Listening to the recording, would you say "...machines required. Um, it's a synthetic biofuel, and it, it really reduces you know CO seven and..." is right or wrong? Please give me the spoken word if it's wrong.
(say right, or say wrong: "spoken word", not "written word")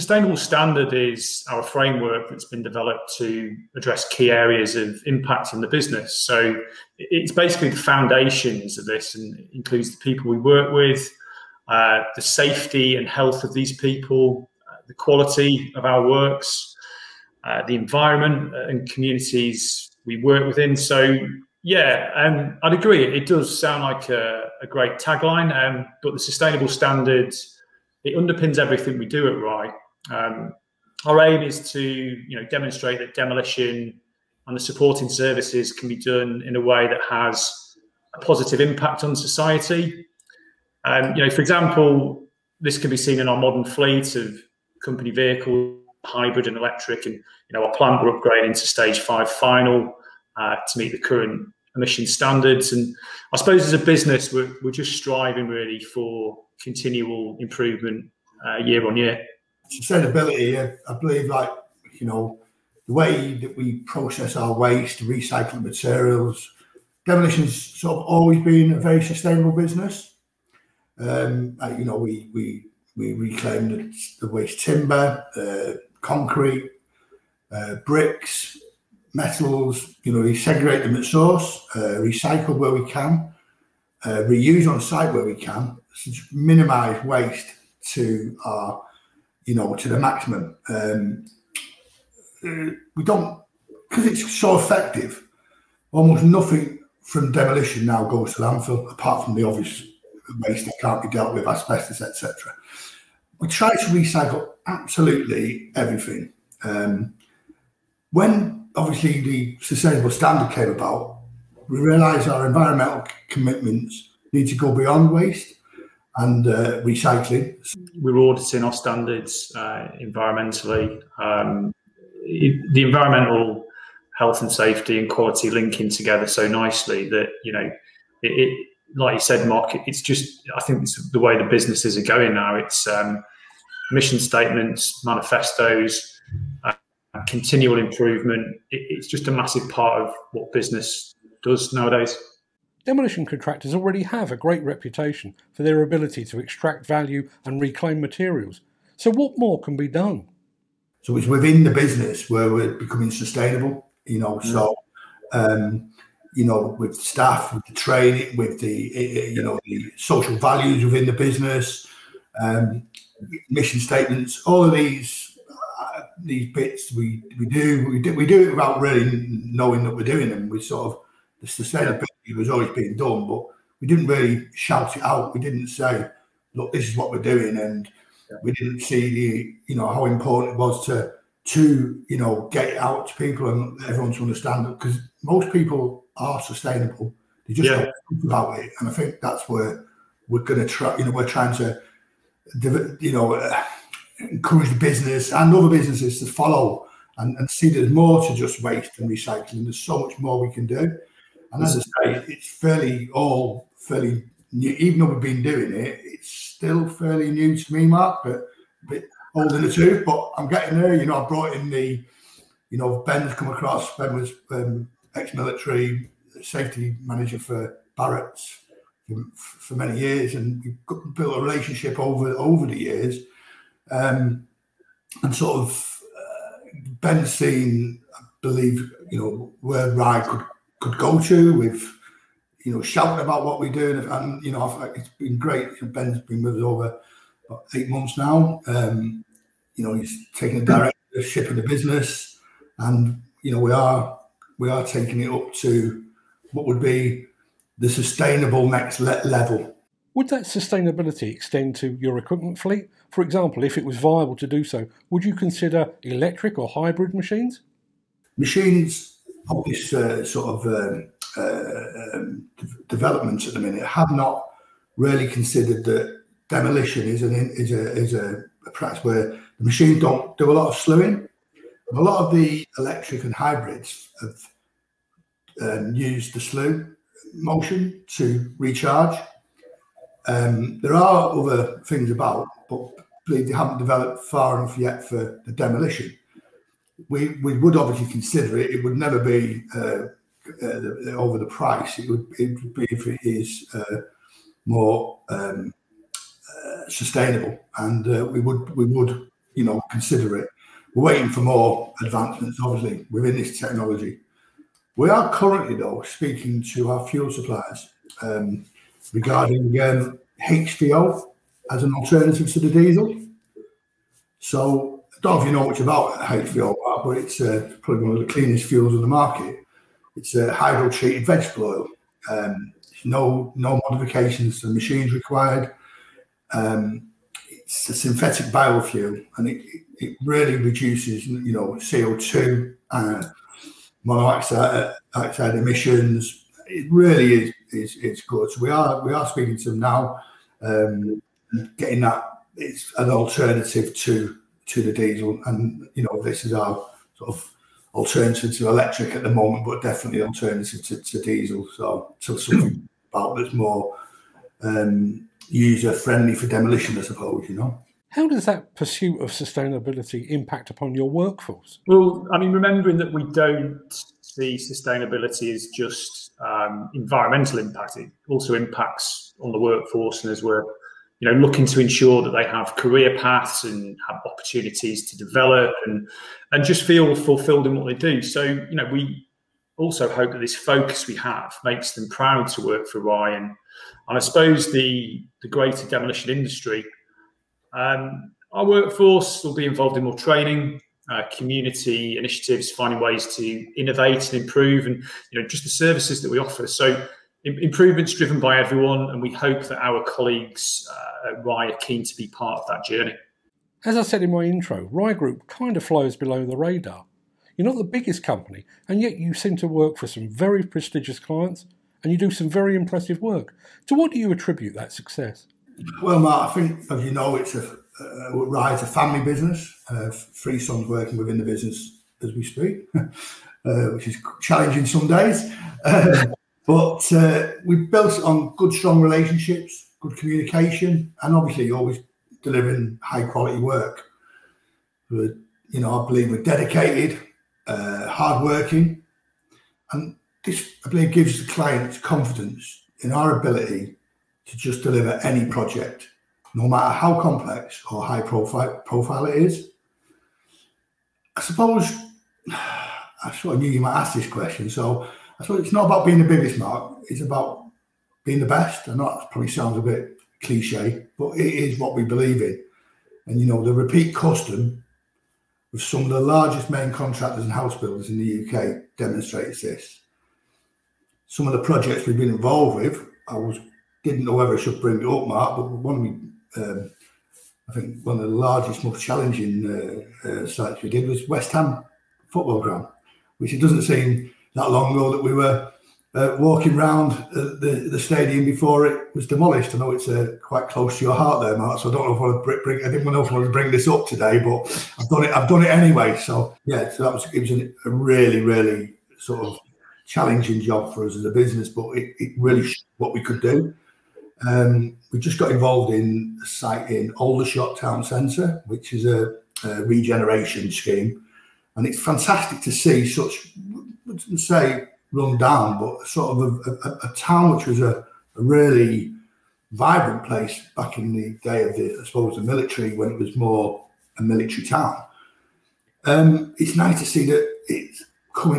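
wrong: "two", not "seven".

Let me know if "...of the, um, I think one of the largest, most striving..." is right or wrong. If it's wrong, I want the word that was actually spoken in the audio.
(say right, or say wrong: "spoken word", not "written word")
wrong: "challenging", not "striving".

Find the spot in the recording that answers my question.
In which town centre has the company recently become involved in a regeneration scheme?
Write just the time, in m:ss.
8:27.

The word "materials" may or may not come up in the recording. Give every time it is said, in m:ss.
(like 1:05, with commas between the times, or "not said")
1:05, 2:28.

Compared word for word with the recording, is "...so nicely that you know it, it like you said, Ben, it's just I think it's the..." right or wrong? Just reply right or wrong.
wrong.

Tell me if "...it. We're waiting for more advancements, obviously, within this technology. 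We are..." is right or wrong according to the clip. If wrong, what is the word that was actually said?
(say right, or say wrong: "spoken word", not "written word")
right.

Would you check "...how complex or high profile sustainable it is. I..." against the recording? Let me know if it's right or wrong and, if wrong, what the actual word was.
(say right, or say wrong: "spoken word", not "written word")
wrong: "profile", not "sustainable".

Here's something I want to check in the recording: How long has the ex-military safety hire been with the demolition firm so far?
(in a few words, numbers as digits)
Over eight months.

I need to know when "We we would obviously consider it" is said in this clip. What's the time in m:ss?
4:47.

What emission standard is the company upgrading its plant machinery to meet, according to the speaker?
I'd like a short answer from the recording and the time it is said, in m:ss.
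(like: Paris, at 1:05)
Stage 5 final, at 0:48.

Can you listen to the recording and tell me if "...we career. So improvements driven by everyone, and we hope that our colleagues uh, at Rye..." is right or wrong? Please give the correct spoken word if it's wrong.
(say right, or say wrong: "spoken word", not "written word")
wrong: "offer", not "career".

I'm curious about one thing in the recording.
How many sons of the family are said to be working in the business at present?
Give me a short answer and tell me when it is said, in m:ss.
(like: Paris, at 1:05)
3, at 7:00.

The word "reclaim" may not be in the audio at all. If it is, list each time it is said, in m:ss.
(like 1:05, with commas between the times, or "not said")
1:13, 2:27.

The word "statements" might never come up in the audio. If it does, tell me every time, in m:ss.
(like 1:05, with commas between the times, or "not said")
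2:14, 2:43.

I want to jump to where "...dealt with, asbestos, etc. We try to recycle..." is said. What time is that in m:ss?
1:41.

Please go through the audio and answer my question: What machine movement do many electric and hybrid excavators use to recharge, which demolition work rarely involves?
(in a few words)
Slewing.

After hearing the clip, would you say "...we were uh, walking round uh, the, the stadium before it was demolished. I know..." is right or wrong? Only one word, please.
right.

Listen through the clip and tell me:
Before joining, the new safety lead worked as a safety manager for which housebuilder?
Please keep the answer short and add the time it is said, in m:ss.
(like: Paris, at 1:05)
Barratt's, at 3:37.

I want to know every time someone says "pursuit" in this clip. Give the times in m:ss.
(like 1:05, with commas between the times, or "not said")
5:58.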